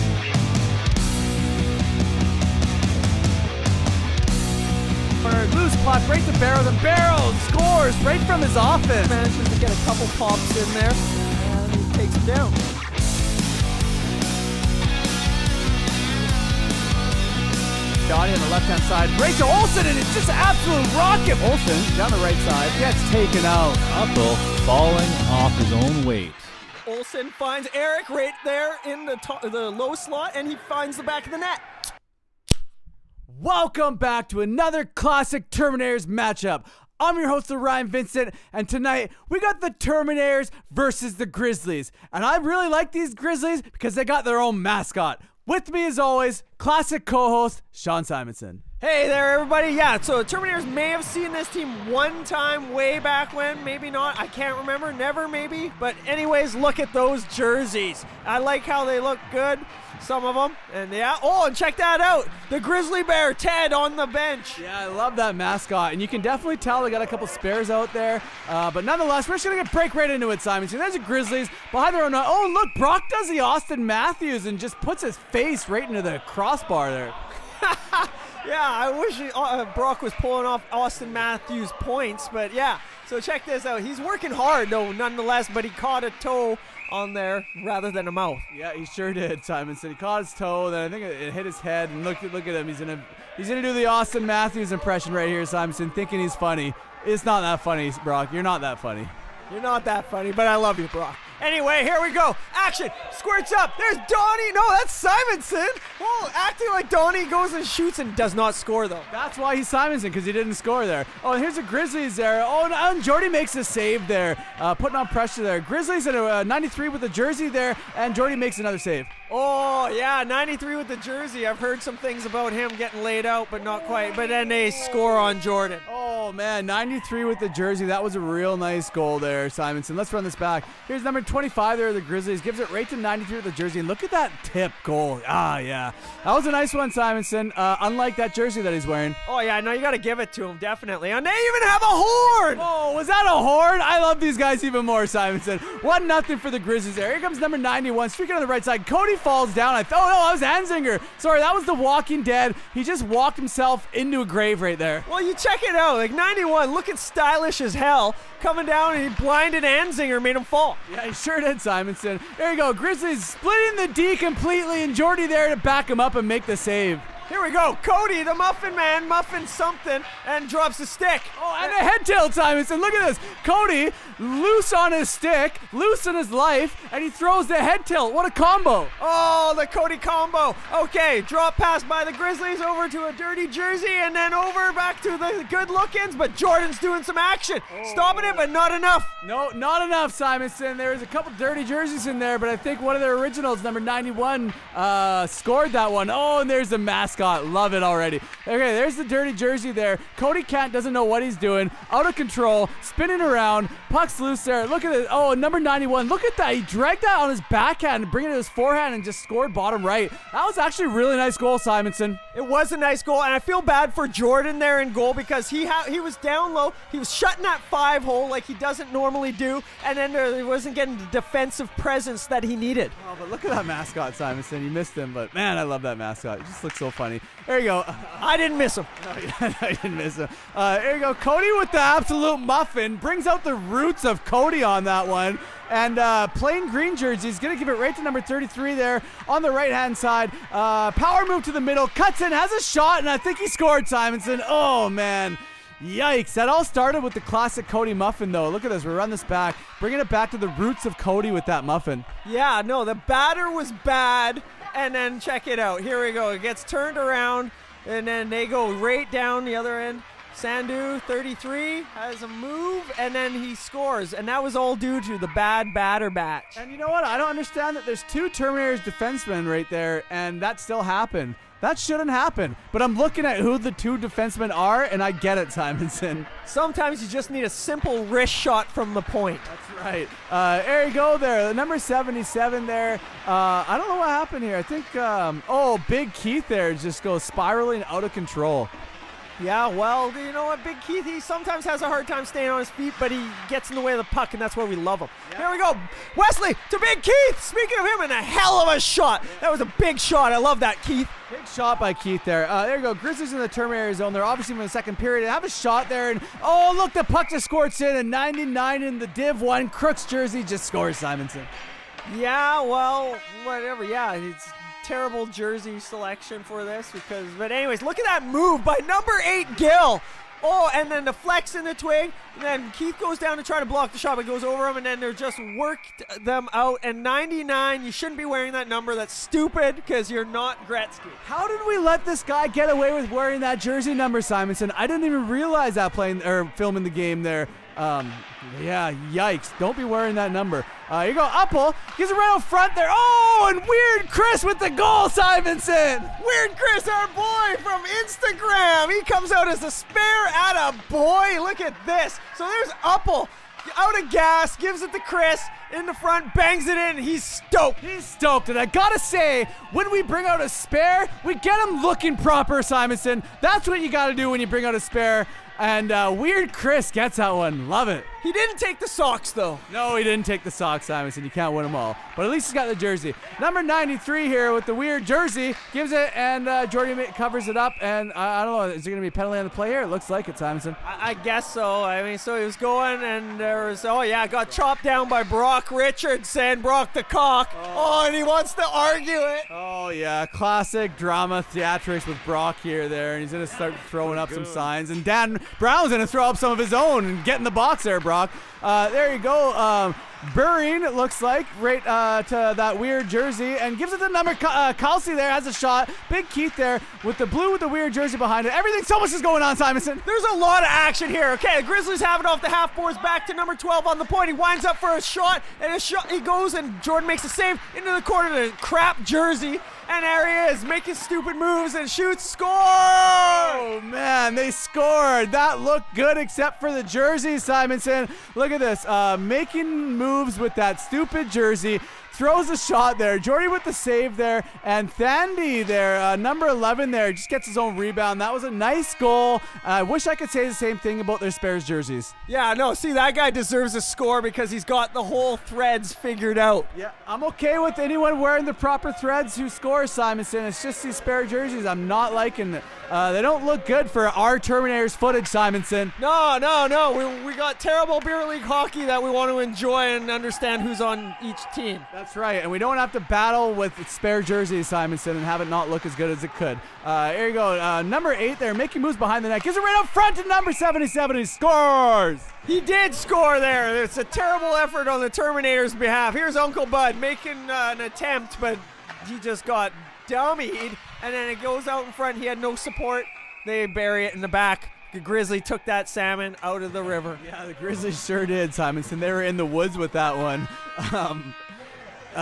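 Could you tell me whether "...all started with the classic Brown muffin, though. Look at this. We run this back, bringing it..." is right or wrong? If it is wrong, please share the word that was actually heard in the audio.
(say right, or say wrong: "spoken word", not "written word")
wrong: "Cody", not "Brown".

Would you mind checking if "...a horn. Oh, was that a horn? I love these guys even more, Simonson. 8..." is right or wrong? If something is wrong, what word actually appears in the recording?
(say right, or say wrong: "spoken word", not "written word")
wrong: "1", not "8".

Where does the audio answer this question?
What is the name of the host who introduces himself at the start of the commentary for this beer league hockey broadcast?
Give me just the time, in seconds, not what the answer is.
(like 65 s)
37 s.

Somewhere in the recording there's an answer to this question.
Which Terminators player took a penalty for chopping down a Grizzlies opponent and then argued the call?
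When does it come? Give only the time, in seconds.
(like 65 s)
385 s.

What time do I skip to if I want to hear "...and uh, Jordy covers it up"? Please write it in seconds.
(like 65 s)
376 s.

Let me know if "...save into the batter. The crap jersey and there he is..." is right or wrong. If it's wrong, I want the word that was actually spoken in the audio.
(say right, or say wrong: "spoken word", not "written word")
wrong: "corner", not "batter".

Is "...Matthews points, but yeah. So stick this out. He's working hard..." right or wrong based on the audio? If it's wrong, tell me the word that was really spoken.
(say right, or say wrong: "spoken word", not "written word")
wrong: "check", not "stick".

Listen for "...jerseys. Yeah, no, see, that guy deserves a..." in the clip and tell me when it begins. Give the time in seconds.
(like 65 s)
441 s.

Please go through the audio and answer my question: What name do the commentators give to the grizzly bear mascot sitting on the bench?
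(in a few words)
Ted.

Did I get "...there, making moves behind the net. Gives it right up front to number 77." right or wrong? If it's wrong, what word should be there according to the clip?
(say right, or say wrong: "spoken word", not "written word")
right.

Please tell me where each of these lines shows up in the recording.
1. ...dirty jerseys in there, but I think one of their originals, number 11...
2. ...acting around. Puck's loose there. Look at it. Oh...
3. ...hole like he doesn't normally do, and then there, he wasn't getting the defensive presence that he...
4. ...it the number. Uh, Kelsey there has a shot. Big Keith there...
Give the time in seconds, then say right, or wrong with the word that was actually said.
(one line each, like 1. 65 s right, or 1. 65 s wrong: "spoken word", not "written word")
1. 191 s wrong: "91", not "11"
2. 202 s wrong: "spinning", not "acting"
3. 218 s right
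4. 403 s right.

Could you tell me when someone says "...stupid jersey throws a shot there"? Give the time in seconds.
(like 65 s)
430 s.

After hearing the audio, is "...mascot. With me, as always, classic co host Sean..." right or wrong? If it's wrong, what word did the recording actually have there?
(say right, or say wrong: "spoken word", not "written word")
right.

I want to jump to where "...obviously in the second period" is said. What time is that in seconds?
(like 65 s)
304 s.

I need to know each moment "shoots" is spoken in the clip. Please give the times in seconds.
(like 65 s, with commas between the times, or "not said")
107 s, 421 s.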